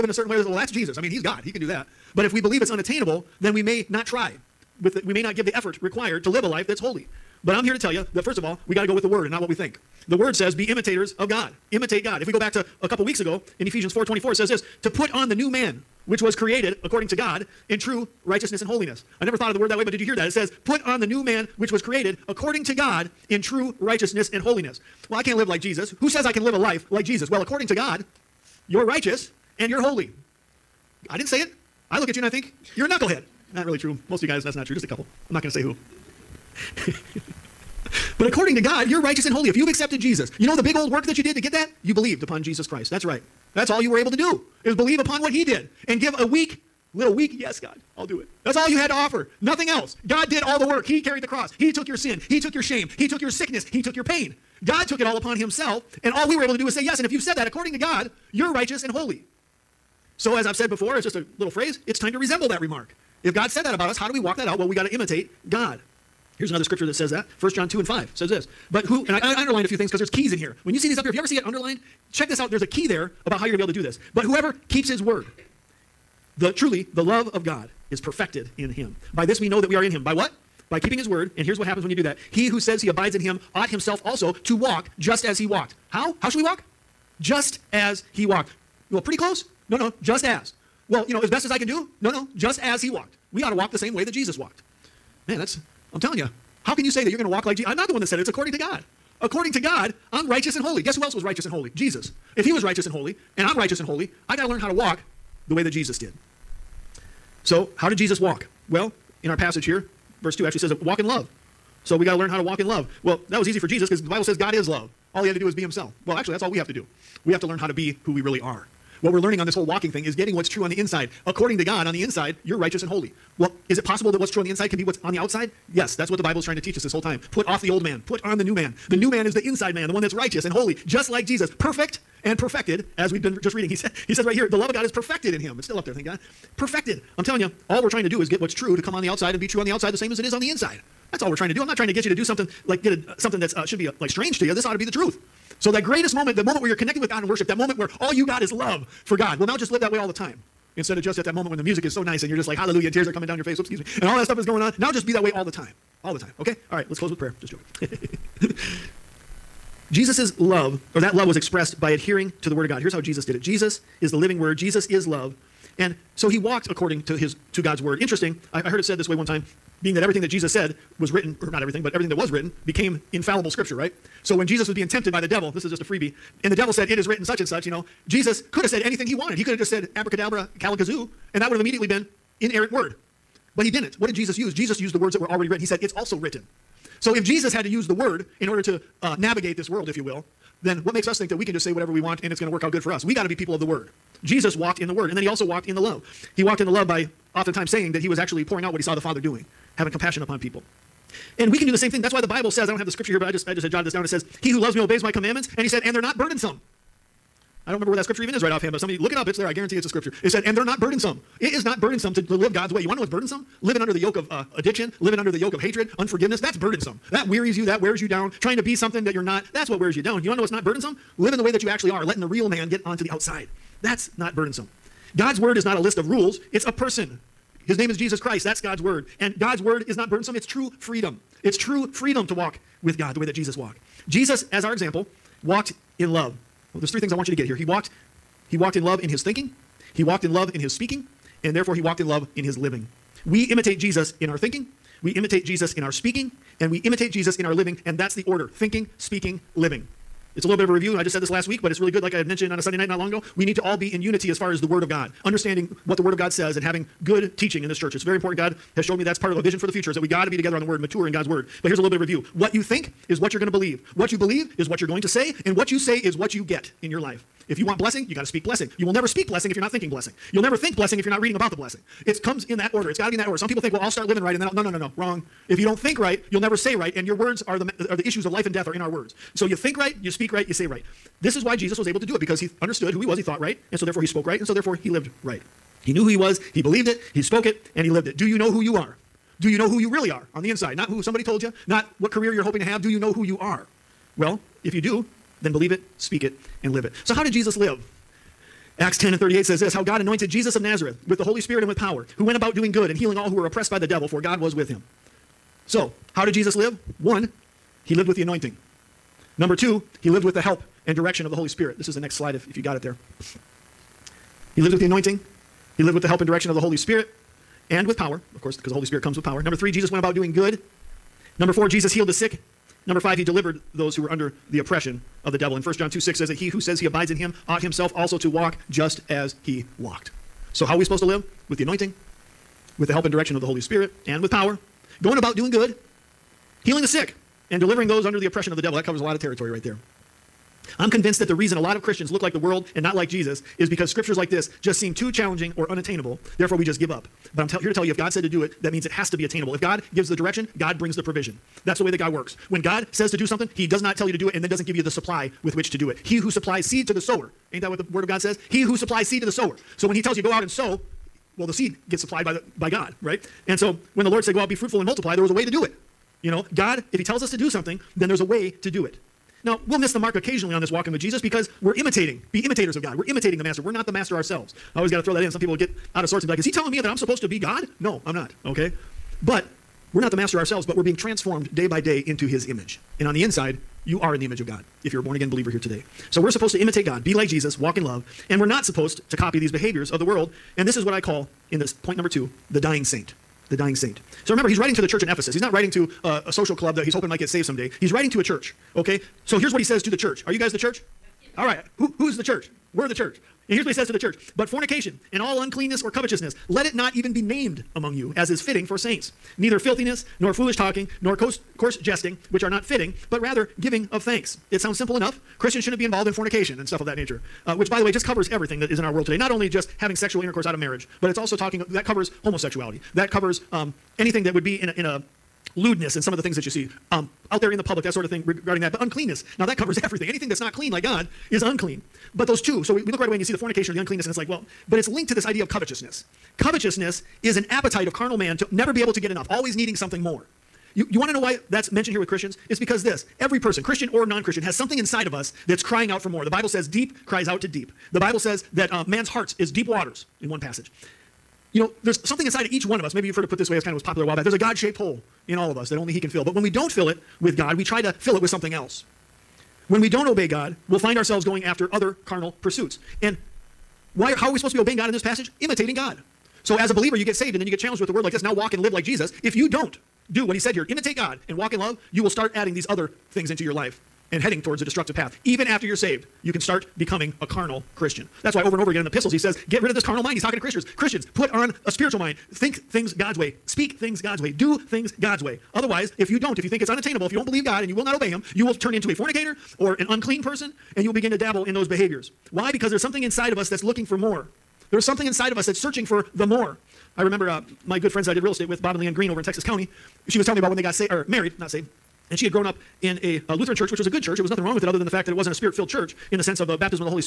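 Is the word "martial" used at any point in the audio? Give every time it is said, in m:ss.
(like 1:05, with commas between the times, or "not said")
not said.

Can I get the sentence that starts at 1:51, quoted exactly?
So we got to learn how to walk in love.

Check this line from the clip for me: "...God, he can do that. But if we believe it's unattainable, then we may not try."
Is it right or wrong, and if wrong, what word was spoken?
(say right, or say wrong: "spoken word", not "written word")
right.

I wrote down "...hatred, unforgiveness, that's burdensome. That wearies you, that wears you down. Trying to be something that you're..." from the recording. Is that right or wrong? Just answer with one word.
right.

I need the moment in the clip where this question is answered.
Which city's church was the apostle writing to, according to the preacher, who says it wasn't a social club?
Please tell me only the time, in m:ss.
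6:35.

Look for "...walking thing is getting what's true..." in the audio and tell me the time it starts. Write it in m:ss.
1:59.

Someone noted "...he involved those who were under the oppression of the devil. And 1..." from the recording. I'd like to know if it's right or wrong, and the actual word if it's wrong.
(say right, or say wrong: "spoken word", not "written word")
wrong: "delivered", not "involved".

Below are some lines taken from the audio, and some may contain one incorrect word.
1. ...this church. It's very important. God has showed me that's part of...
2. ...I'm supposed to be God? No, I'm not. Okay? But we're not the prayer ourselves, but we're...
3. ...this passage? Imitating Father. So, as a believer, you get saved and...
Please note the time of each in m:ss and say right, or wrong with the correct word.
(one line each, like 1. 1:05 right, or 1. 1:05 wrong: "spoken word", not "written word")
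1. 4:17 right
2. 6:16 wrong: "master", not "prayer"
3. 7:44 wrong: "God", not "Father".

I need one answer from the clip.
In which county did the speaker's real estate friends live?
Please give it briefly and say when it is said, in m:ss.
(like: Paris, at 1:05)
Texas County, at 8:19.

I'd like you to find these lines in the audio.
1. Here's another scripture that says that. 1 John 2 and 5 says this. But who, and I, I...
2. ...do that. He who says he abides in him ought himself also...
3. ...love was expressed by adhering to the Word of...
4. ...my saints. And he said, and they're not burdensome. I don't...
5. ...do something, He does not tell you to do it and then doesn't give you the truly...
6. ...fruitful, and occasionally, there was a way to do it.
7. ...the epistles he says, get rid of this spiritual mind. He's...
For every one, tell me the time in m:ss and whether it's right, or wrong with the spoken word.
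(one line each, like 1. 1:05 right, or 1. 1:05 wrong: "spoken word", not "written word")
1. 1:06 right
2. 1:21 right
3. 2:41 right
4. 3:25 wrong: "commandments", not "saints"
5. 5:53 wrong: "supply", not "truly"
6. 6:04 wrong: "multiply", not "occasionally"
7. 7:58 wrong: "carnal", not "spiritual".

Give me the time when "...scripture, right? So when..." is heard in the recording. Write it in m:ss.
2:53.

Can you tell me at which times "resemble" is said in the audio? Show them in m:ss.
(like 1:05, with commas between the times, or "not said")
1:02.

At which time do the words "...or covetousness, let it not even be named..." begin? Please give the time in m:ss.
6:45.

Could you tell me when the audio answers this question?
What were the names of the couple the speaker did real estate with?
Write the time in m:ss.
8:18.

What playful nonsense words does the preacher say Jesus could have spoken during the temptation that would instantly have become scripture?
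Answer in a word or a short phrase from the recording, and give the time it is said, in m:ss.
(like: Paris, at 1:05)
abracadabra, calakazoo, at 2:59.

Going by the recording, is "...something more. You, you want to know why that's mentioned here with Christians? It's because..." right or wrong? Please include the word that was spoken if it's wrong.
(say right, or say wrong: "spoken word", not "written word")
right.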